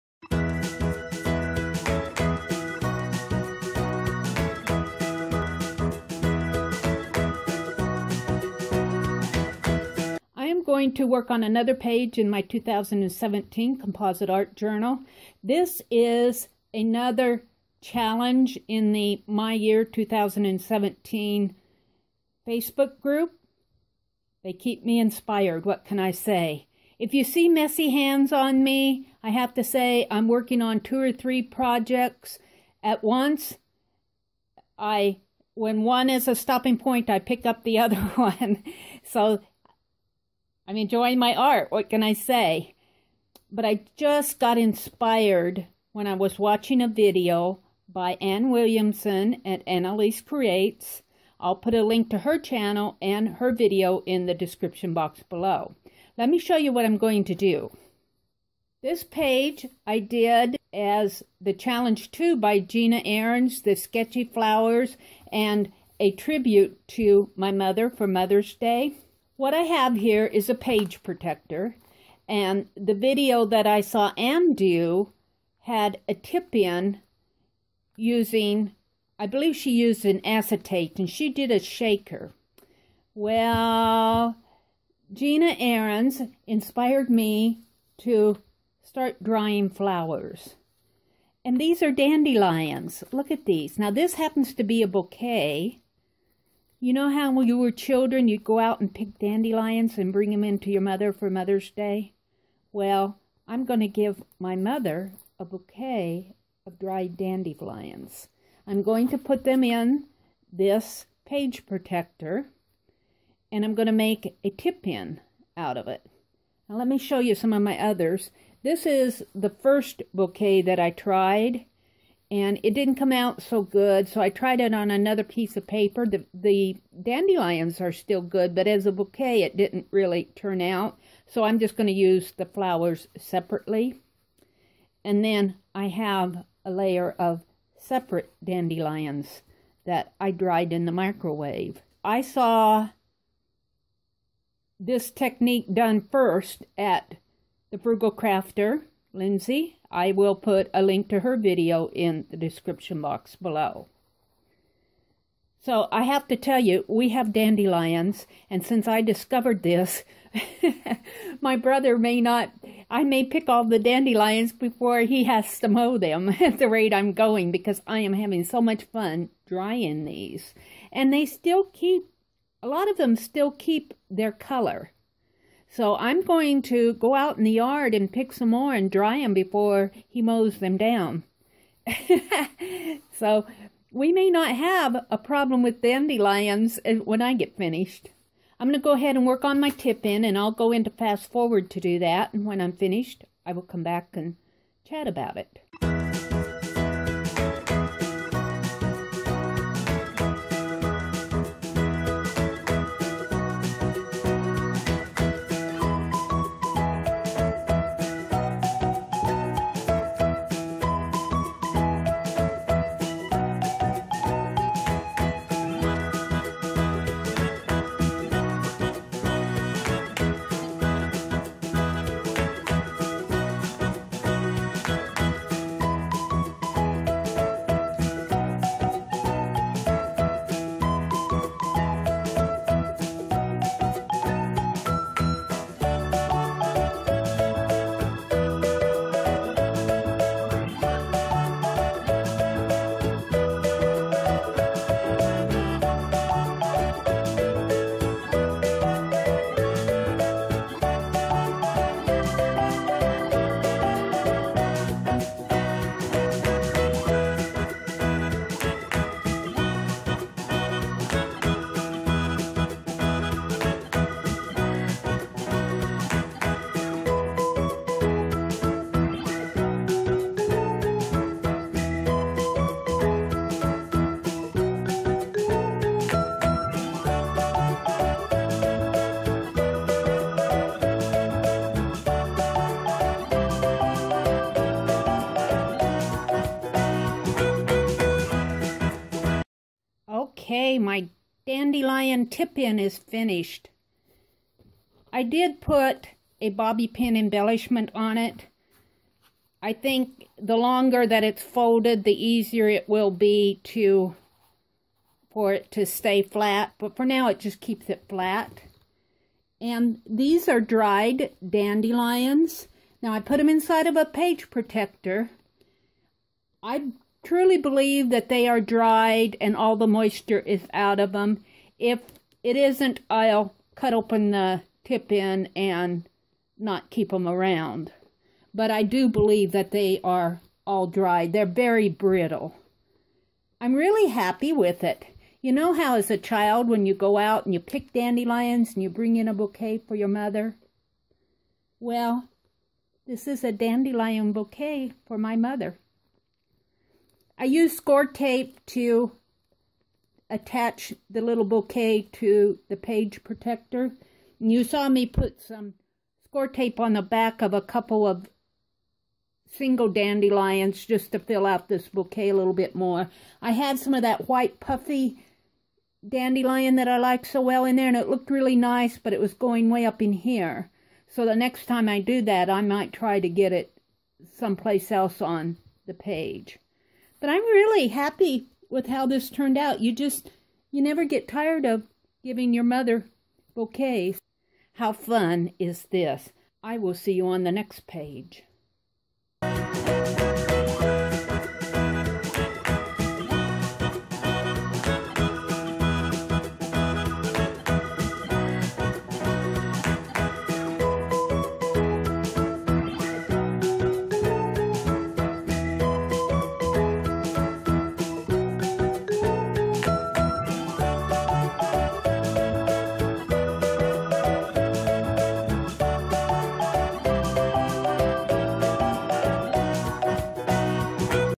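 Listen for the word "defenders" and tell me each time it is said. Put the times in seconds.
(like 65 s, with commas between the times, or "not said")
not said.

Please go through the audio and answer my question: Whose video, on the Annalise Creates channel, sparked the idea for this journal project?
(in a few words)
Anne Williamson.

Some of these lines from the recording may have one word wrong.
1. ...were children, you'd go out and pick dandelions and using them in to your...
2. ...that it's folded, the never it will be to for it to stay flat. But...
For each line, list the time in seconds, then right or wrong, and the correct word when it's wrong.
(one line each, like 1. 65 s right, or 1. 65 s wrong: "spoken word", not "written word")
1. 97 s wrong: "bring", not "using"
2. 301 s wrong: "easier", not "never".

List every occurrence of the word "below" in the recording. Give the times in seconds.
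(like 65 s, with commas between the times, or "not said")
55 s, 153 s.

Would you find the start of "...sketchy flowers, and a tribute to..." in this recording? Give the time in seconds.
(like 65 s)
63 s.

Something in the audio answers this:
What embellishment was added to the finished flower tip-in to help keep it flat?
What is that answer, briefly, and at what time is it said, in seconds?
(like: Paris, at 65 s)
bobby pin, at 296 s.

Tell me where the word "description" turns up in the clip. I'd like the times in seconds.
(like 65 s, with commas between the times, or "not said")
54 s, 152 s.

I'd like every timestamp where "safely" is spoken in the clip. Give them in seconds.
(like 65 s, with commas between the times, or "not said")
not said.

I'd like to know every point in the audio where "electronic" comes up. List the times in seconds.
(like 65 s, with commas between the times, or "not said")
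not said.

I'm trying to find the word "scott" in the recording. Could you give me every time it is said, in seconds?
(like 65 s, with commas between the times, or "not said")
not said.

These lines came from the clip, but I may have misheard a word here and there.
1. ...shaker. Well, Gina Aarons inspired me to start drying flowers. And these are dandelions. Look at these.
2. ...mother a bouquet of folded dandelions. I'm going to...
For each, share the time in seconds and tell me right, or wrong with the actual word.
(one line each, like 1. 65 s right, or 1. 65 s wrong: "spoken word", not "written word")
1. 81 s right
2. 104 s wrong: "dried", not "folded".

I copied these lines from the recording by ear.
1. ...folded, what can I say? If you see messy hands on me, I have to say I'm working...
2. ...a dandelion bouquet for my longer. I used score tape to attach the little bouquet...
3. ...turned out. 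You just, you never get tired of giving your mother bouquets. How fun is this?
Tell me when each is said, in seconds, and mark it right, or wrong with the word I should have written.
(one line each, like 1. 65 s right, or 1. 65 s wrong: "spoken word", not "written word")
1. 24 s wrong: "inspired", not "folded"
2. 343 s wrong: "mother", not "longer"
3. 379 s right.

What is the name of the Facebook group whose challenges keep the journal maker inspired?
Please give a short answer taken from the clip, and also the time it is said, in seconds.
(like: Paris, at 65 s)
My Year 2017, at 19 s.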